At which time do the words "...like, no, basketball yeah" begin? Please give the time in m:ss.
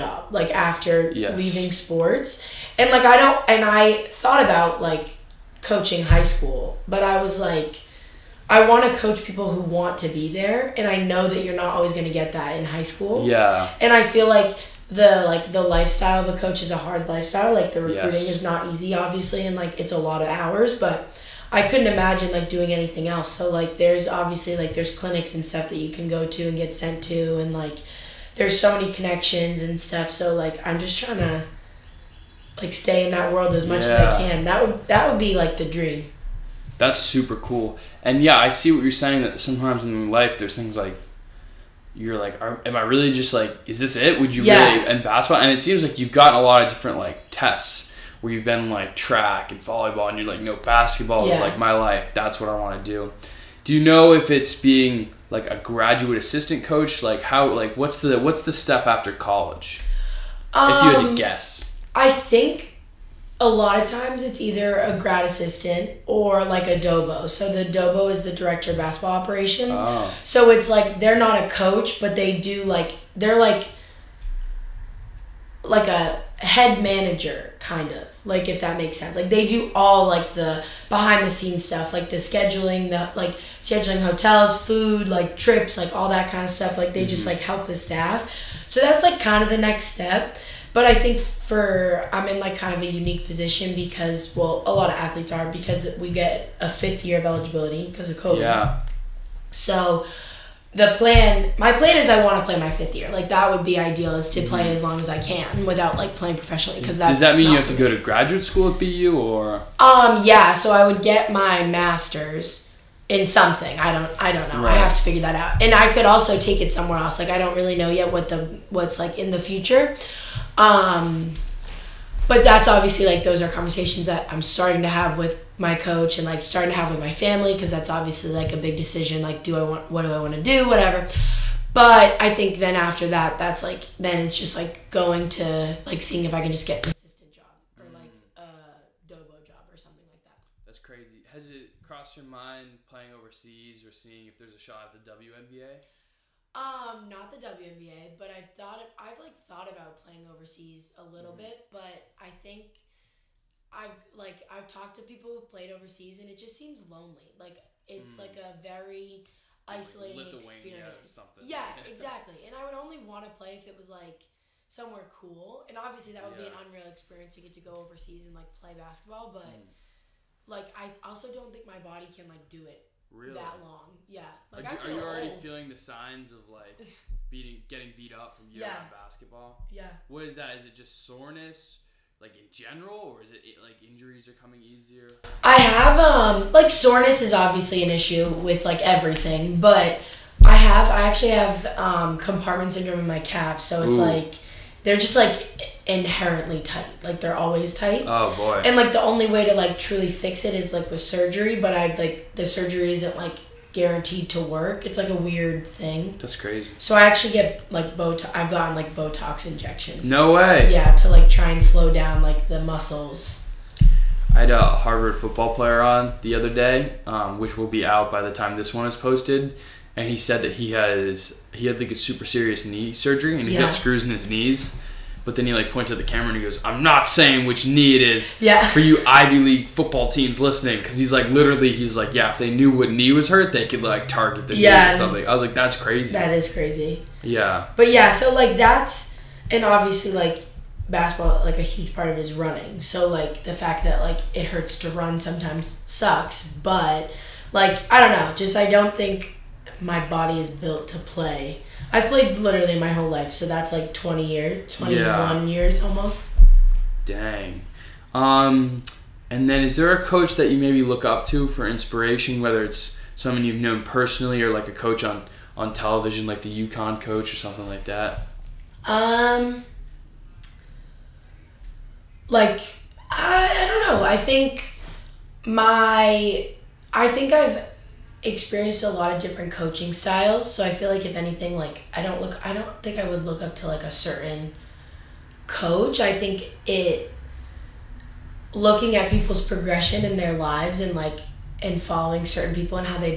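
0:50.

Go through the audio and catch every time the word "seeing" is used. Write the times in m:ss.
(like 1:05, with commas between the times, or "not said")
2:16, 2:23.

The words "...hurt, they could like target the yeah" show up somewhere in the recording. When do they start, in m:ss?
3:53.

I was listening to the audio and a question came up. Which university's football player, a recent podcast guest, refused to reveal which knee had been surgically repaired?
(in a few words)
Harvard.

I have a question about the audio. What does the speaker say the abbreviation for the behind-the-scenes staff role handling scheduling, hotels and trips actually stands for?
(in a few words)
Director of basketball operations.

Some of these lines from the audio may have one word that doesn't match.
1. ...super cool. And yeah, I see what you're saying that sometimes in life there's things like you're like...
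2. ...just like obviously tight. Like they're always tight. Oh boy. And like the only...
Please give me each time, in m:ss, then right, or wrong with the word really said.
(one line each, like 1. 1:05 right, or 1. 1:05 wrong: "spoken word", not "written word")
1. 0:36 right
2. 3:14 wrong: "inherently", not "obviously".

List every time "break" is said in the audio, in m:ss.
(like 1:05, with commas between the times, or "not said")
not said.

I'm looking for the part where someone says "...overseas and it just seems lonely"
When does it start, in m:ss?
2:35.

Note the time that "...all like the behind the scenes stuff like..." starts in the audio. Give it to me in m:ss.
1:19.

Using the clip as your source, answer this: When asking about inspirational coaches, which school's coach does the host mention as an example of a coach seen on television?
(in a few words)
UConn.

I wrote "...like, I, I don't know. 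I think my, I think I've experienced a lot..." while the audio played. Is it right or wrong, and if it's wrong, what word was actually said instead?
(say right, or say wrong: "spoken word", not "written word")
right.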